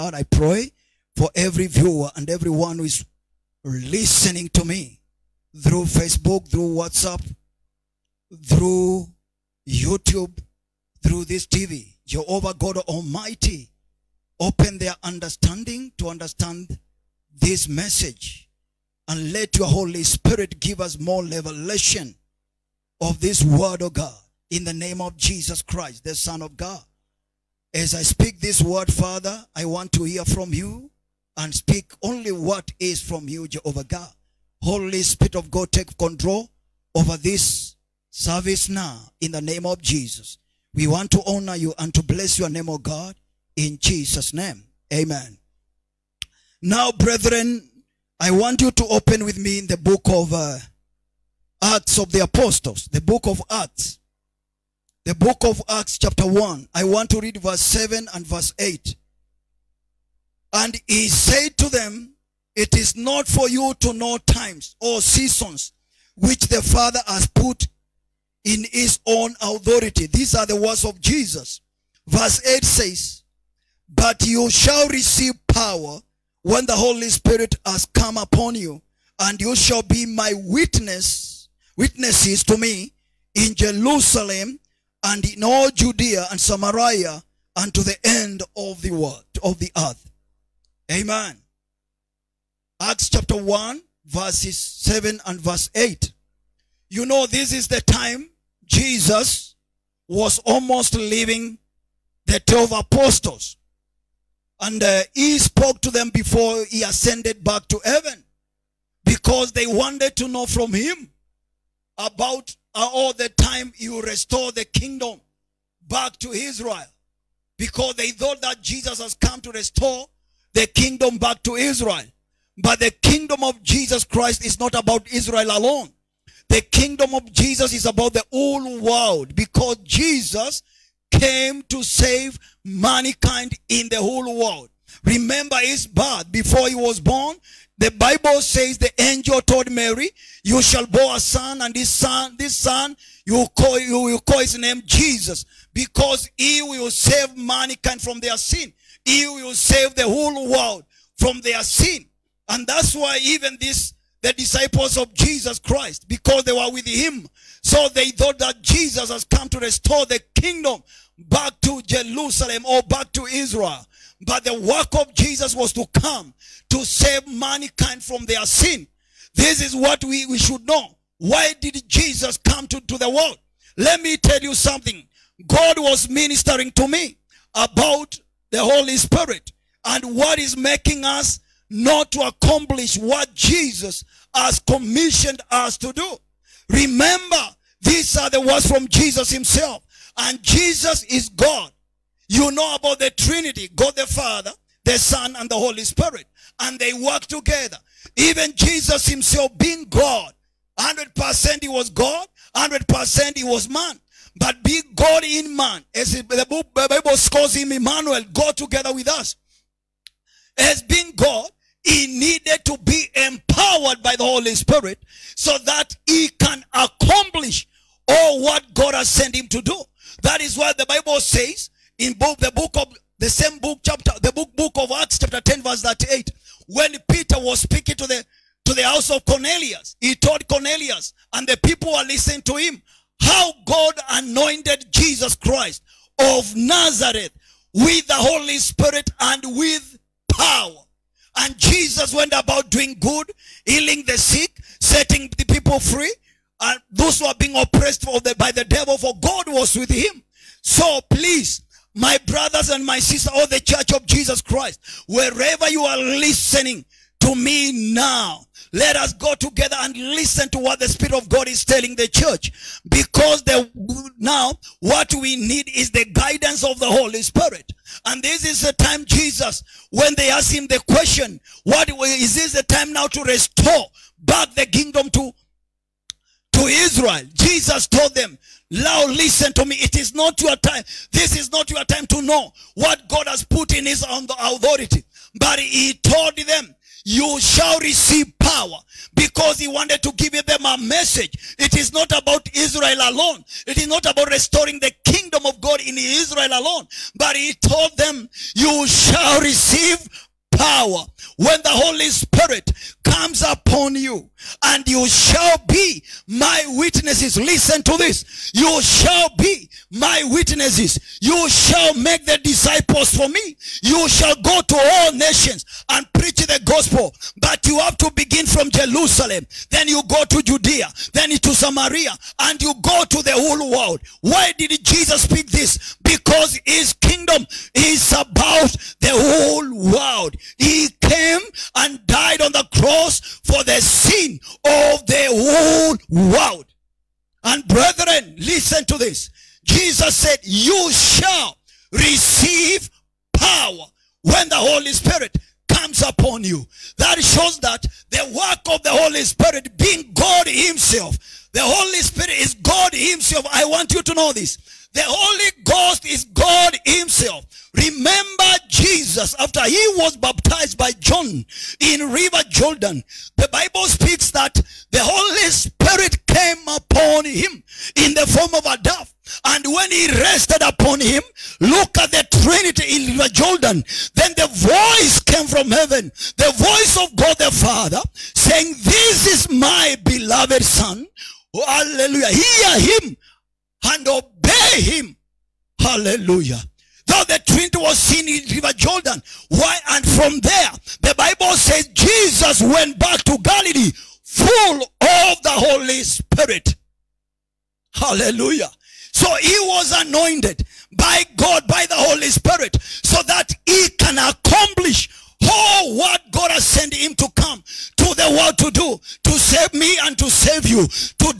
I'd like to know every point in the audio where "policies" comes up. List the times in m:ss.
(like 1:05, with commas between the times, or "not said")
not said.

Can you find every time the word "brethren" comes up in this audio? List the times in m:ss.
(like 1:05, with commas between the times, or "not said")
0:46, 5:37.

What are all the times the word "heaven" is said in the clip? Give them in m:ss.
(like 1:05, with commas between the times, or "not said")
1:47, 6:15.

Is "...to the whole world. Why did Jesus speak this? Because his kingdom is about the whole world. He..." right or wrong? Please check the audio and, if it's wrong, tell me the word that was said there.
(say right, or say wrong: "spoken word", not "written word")
right.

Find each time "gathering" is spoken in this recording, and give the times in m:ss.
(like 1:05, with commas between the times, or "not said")
not said.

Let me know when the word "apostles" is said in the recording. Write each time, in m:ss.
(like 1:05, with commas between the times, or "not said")
0:52, 1:42.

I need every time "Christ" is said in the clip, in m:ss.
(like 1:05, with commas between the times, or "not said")
0:25, 2:04, 2:35, 3:55, 4:14.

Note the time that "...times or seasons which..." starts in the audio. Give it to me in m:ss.
1:04.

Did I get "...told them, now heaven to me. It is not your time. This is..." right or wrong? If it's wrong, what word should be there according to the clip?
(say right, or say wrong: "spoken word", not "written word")
wrong: "listen", not "heaven".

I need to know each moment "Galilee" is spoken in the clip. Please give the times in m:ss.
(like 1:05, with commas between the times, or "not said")
6:33.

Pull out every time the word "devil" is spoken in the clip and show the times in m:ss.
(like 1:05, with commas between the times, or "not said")
4:08.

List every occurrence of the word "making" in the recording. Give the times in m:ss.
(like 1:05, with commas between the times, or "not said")
3:00.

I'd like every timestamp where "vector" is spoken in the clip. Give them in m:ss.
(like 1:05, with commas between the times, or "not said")
not said.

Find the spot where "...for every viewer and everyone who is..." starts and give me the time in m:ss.
0:01.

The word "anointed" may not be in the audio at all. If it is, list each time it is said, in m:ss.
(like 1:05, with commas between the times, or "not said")
3:54, 6:40.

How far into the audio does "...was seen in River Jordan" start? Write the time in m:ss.
6:27.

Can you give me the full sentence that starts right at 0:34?
Holy Spirit of God, take control over this service now in the name of Jesus.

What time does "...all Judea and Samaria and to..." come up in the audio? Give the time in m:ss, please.
1:25.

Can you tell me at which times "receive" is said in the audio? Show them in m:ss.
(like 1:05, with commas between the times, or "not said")
1:14, 4:47, 4:59, 5:41.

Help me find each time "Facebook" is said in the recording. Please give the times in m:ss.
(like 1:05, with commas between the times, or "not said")
0:05.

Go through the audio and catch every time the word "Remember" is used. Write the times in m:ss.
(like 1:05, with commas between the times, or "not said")
2:15, 3:06, 5:57.